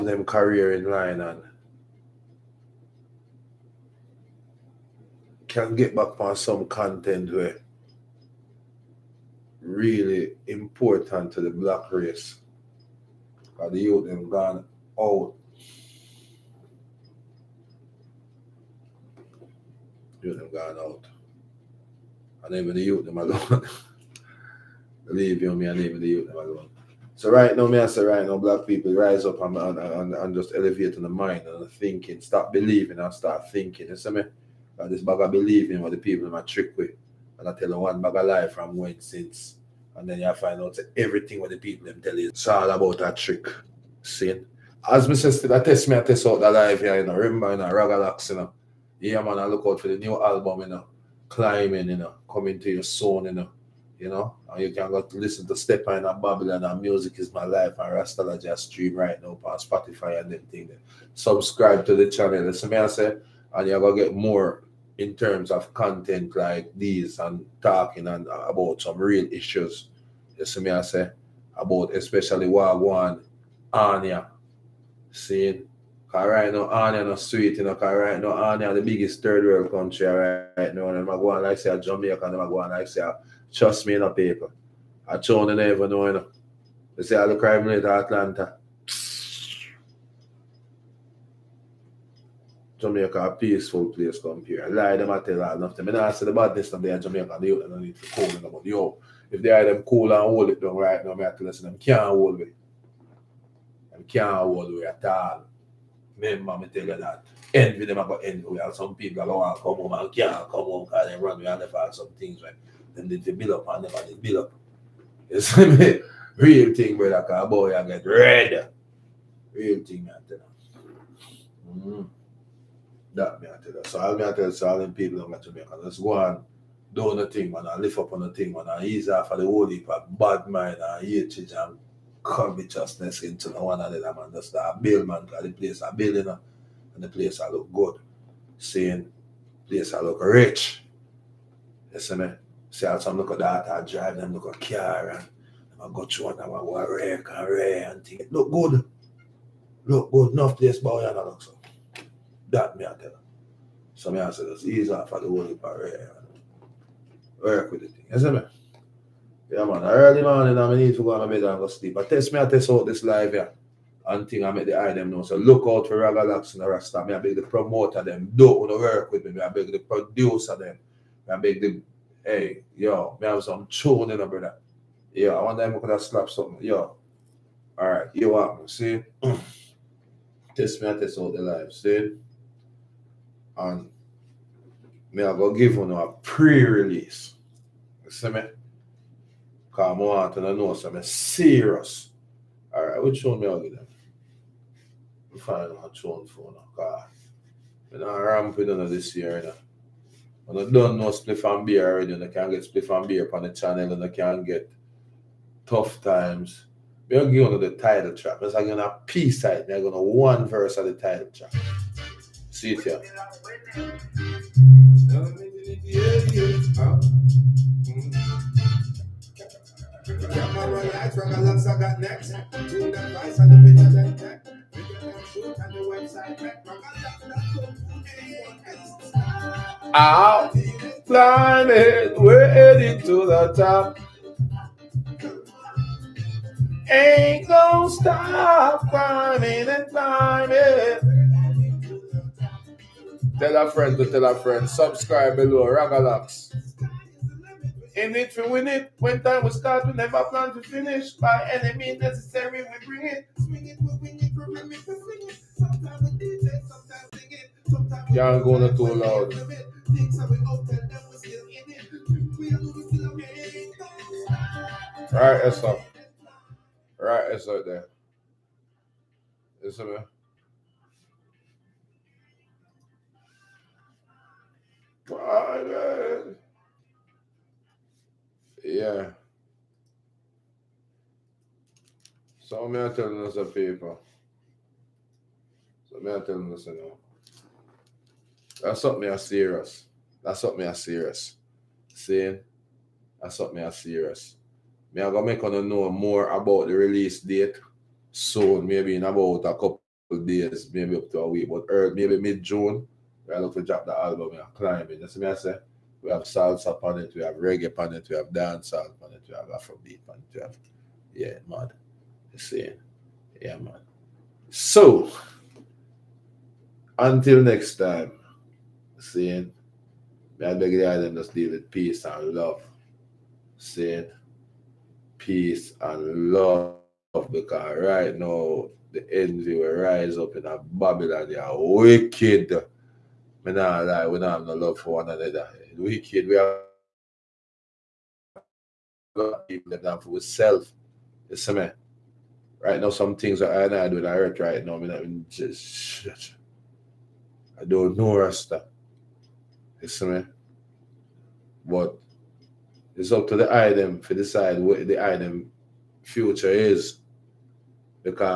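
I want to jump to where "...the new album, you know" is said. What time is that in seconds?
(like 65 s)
49 s.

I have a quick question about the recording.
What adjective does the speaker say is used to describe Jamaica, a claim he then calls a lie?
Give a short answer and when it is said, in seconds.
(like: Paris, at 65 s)
peaceful, at 93 s.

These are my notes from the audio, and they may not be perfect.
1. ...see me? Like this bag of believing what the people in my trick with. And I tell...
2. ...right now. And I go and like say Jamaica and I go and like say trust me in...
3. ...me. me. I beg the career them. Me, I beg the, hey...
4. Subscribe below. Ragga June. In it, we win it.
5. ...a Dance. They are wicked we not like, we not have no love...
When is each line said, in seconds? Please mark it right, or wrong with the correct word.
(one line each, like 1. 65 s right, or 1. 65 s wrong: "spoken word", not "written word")
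1. 33 s right
2. 80 s right
3. 169 s wrong: "producer", not "career"
4. 244 s wrong: "Lox", not "June"
5. 330 s wrong: "Babylon", not "Dance".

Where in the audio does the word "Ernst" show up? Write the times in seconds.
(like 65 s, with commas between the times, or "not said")
not said.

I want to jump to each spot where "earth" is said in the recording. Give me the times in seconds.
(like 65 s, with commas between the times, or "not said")
344 s.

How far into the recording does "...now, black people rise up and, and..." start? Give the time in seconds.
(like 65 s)
28 s.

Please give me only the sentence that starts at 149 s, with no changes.
Look good, enough place, but I don't look so.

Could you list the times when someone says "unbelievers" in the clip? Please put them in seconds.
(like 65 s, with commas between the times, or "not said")
not said.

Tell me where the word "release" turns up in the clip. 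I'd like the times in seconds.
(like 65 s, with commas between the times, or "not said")
186 s, 296 s.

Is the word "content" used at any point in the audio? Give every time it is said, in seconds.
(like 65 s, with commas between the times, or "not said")
6 s, 65 s.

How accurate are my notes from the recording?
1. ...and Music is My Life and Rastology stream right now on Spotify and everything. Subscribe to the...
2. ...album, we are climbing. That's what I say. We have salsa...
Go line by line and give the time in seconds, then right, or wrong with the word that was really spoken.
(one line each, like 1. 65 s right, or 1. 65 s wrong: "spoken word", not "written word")
1. 56 s right
2. 303 s right.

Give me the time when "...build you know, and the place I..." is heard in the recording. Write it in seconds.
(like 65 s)
135 s.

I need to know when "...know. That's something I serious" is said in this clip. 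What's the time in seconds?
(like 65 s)
286 s.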